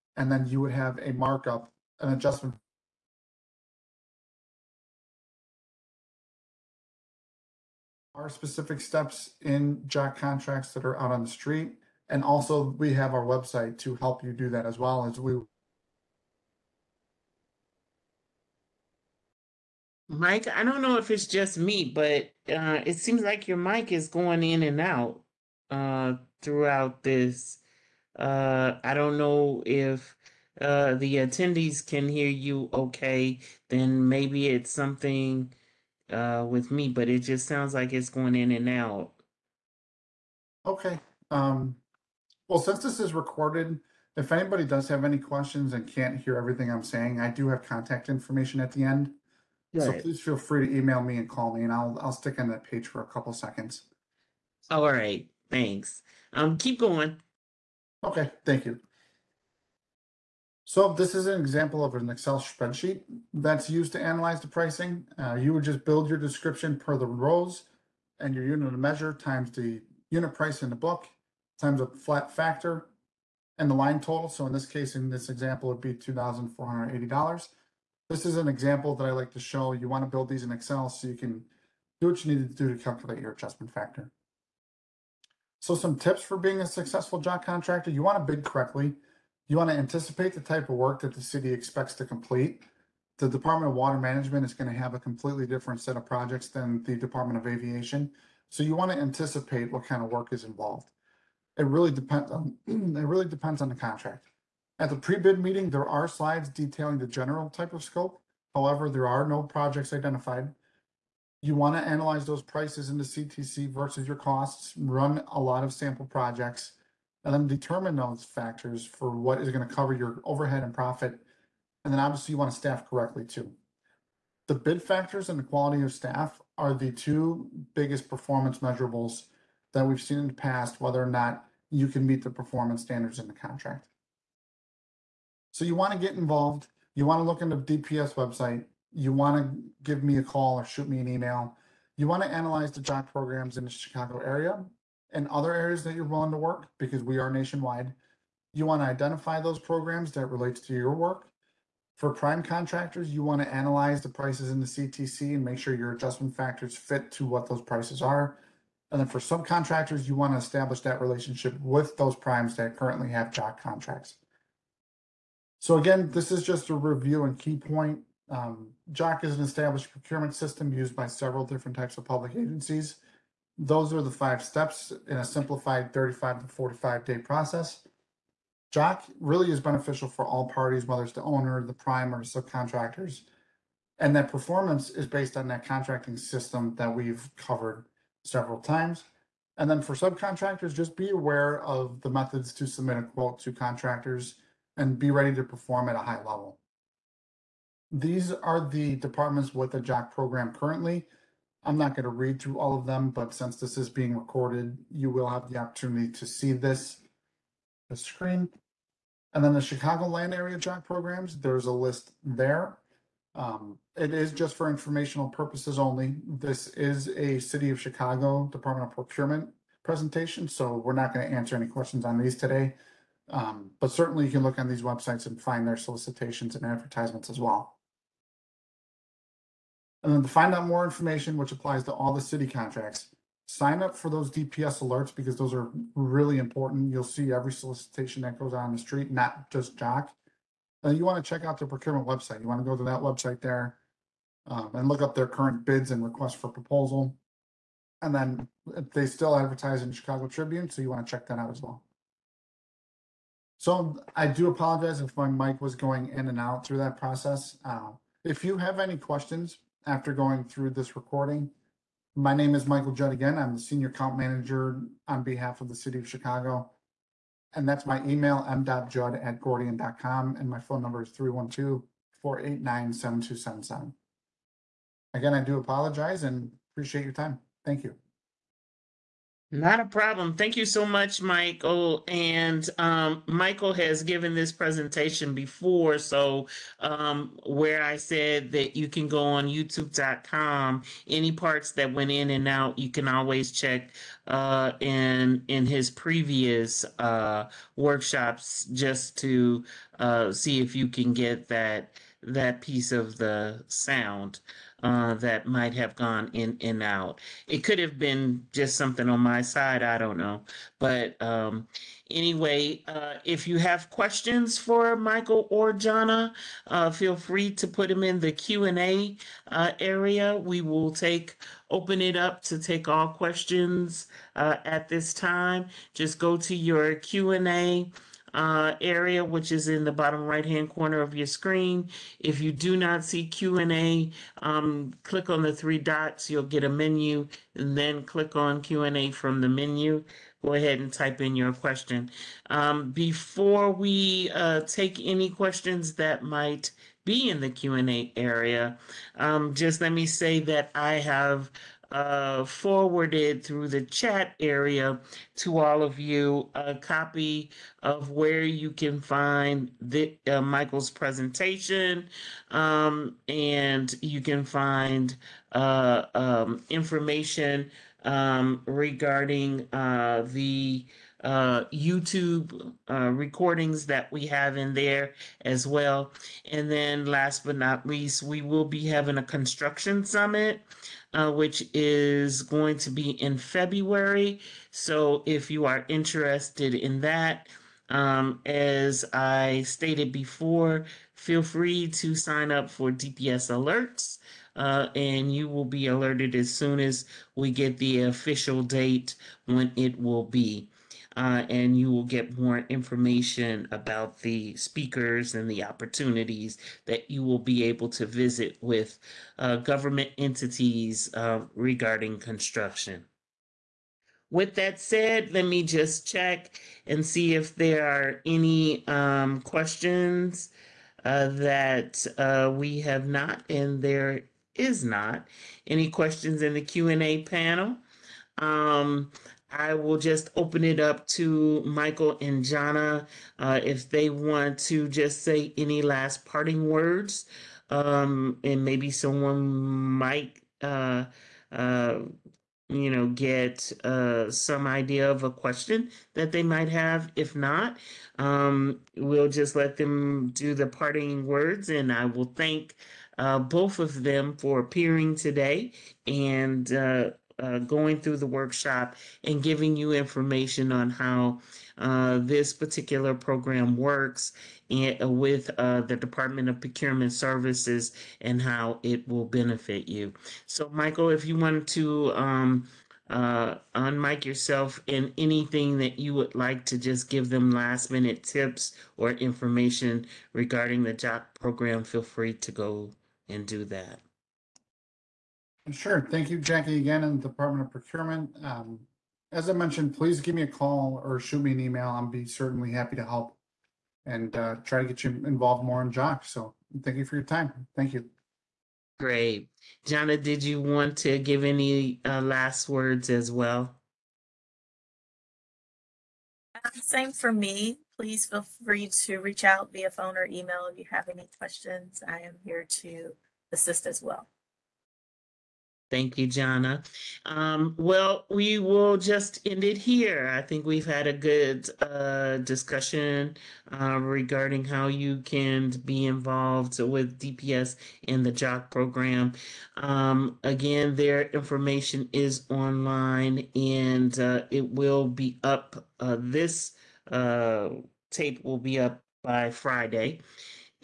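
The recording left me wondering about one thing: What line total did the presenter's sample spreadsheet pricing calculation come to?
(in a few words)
$2,480.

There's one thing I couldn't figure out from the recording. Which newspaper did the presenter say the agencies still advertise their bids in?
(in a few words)
Chicago Tribune.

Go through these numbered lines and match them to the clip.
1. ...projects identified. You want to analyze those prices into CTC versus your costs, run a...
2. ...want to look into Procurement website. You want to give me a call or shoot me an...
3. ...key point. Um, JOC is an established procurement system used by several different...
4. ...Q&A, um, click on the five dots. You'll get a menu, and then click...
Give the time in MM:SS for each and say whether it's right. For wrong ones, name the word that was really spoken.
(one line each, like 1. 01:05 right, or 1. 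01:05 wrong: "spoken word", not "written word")
1. 01:49 right
2. 02:17 wrong: "DPS", not "Procurement"
3. 02:47 right
4. 05:33 wrong: "three", not "five".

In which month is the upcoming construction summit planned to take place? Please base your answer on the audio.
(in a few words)
February.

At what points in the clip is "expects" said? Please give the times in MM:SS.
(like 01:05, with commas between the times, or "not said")
01:31.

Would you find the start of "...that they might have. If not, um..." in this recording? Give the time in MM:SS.
07:26.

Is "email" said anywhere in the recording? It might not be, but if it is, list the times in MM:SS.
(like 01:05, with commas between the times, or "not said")
00:50, 02:21, 04:28, 08:11, 08:30.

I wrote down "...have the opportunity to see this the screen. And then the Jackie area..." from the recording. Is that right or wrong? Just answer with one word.
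wrong.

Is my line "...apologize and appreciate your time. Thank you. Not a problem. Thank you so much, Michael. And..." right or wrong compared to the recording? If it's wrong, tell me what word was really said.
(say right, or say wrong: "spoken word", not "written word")
right.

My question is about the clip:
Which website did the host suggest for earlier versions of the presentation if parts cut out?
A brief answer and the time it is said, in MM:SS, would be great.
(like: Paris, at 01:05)
youtube.com, at 04:49.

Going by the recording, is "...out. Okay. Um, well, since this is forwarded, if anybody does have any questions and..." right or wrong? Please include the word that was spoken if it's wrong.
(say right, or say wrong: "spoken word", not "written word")
wrong: "recorded", not "forwarded".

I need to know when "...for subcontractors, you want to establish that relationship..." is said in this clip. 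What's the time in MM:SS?
02:39.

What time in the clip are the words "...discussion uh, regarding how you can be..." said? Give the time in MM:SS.
08:42.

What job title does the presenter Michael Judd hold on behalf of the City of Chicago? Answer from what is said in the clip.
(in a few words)
Senior Account Manager.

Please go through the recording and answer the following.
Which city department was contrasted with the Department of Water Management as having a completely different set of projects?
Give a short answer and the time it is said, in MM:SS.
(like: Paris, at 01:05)
Department of Aviation, at 01:36.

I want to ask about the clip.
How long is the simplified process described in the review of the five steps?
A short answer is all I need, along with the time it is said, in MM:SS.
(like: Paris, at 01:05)
35 to 45 days, at 02:55.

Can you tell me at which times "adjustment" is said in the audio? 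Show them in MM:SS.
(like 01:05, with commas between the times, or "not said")
00:02, 01:23, 02:35.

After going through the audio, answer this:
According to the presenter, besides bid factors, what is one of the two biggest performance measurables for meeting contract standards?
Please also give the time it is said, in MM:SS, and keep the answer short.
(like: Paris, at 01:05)
quality of staff, at 02:05.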